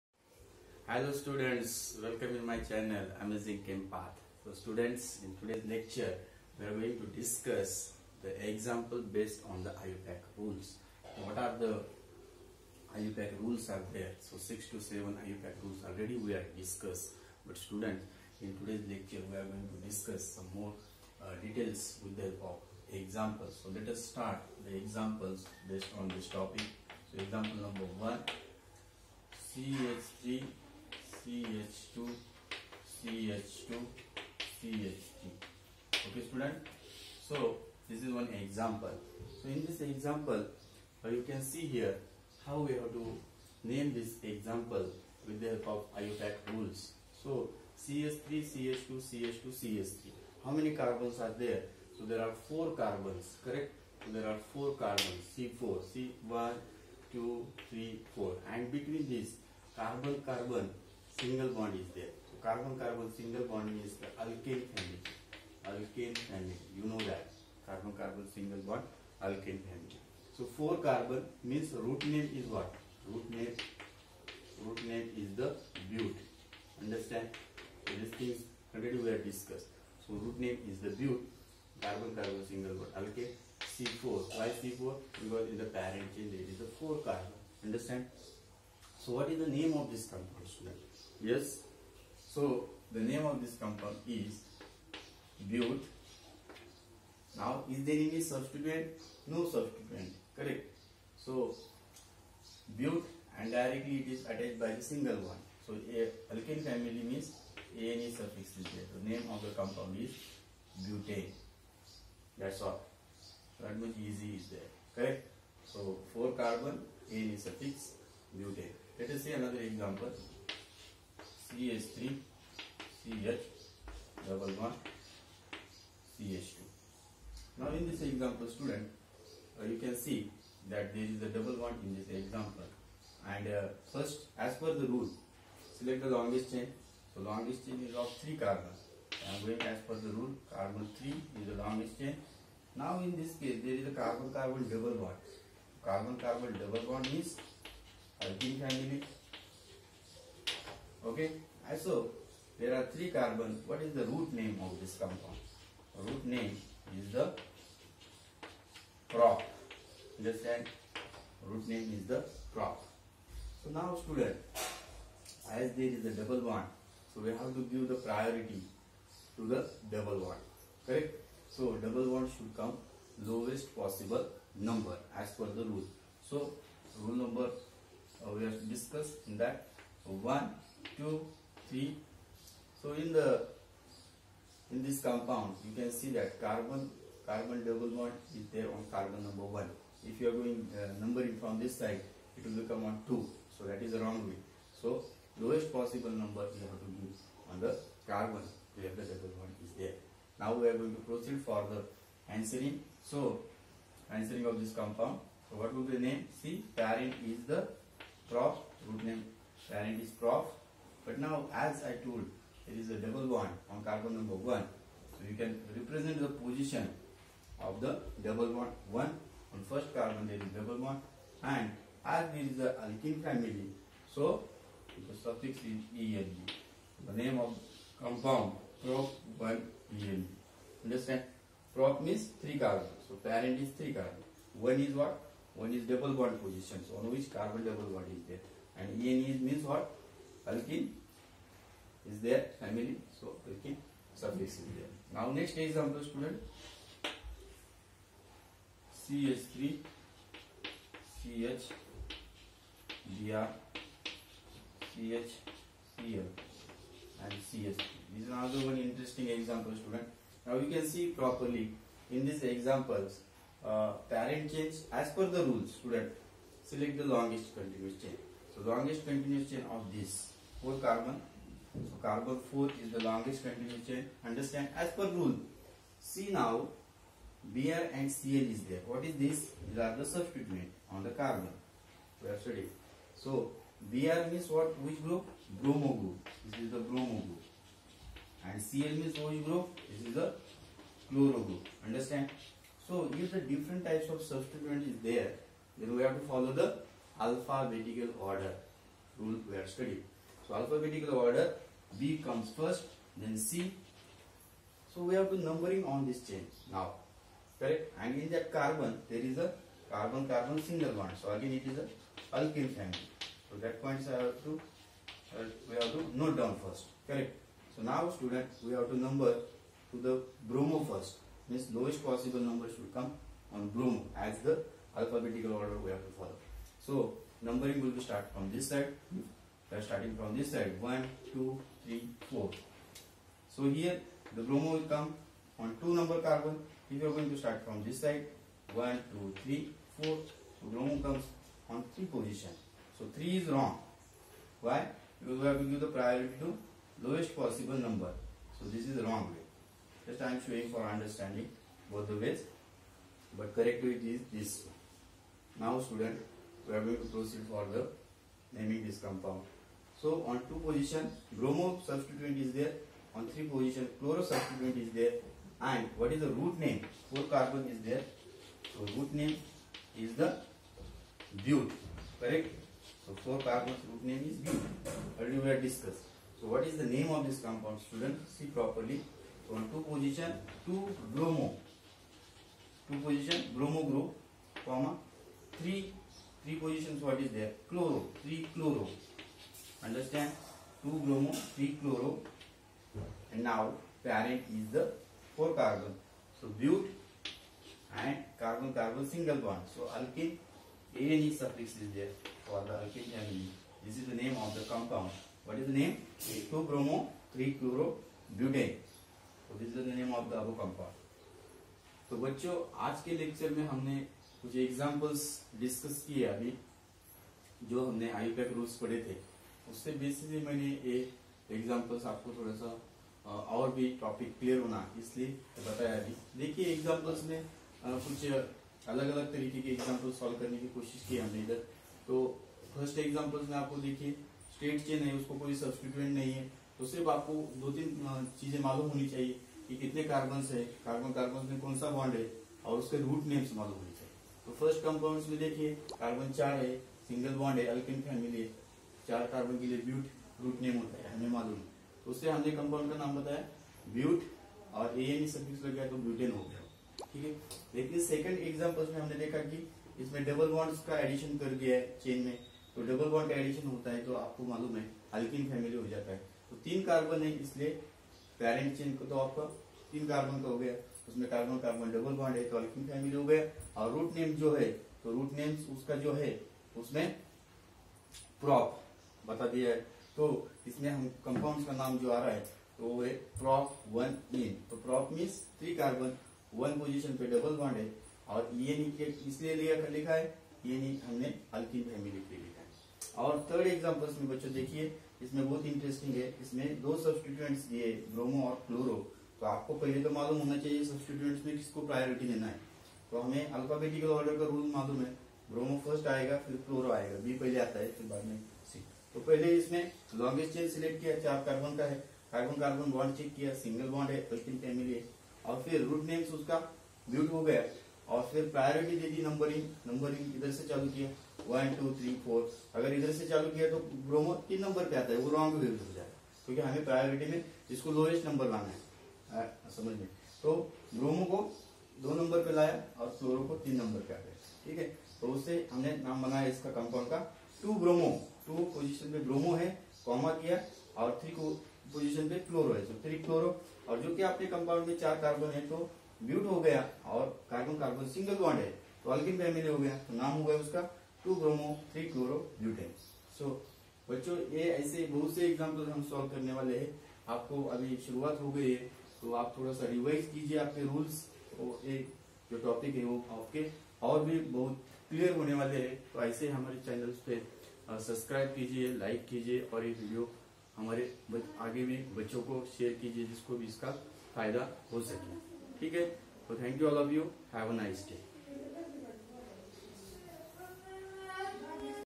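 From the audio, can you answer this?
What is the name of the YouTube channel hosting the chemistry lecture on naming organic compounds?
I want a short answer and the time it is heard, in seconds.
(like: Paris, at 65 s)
Amazing Chem Path, at 3 s.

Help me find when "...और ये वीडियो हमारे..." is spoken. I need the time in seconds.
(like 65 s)
569 s.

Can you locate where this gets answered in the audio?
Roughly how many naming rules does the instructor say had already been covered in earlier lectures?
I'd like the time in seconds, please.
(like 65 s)
14 s.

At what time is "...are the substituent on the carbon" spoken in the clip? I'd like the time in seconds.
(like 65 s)
279 s.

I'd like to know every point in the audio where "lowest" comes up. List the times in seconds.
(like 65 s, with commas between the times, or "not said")
173 s, 195 s, 321 s, 347 s.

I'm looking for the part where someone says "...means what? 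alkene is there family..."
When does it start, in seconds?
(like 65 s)
239 s.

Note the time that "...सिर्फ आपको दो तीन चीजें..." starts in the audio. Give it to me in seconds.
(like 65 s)
436 s.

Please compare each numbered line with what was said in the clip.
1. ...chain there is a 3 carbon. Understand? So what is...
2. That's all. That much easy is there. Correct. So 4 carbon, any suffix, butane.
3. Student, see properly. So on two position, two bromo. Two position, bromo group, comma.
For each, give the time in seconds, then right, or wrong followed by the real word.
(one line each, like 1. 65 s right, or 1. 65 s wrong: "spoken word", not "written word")
1. 86 s wrong: "4", not "3"
2. 112 s right
3. 377 s right.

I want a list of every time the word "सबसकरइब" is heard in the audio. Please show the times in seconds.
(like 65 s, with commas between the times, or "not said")
567 s.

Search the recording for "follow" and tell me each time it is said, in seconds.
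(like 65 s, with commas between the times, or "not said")
296 s, 326 s.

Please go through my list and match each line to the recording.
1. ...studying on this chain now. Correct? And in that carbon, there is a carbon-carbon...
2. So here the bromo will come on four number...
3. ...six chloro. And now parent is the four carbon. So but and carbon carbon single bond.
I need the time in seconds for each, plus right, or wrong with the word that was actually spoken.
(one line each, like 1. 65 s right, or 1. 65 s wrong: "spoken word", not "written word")
1. 305 s wrong: "numbering", not "studying"
2. 333 s wrong: "two", not "four"
3. 391 s wrong: "three", not "six".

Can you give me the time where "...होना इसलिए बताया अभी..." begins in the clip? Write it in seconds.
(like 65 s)
424 s.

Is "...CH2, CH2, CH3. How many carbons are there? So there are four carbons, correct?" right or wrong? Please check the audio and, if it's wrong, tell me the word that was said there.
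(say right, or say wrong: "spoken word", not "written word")
right.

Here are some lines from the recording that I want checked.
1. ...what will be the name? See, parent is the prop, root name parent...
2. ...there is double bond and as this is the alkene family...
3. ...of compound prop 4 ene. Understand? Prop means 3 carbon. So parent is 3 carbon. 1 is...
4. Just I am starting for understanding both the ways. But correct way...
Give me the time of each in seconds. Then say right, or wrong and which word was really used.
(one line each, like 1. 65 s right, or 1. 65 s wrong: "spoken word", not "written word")
1. 205 s right
2. 220 s right
3. 227 s wrong: "1", not "4"
4. 350 s wrong: "showing", not "starting".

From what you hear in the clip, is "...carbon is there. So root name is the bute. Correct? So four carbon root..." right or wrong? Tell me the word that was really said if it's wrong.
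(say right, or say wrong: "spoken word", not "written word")
right.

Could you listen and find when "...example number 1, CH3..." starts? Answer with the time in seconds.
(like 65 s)
27 s.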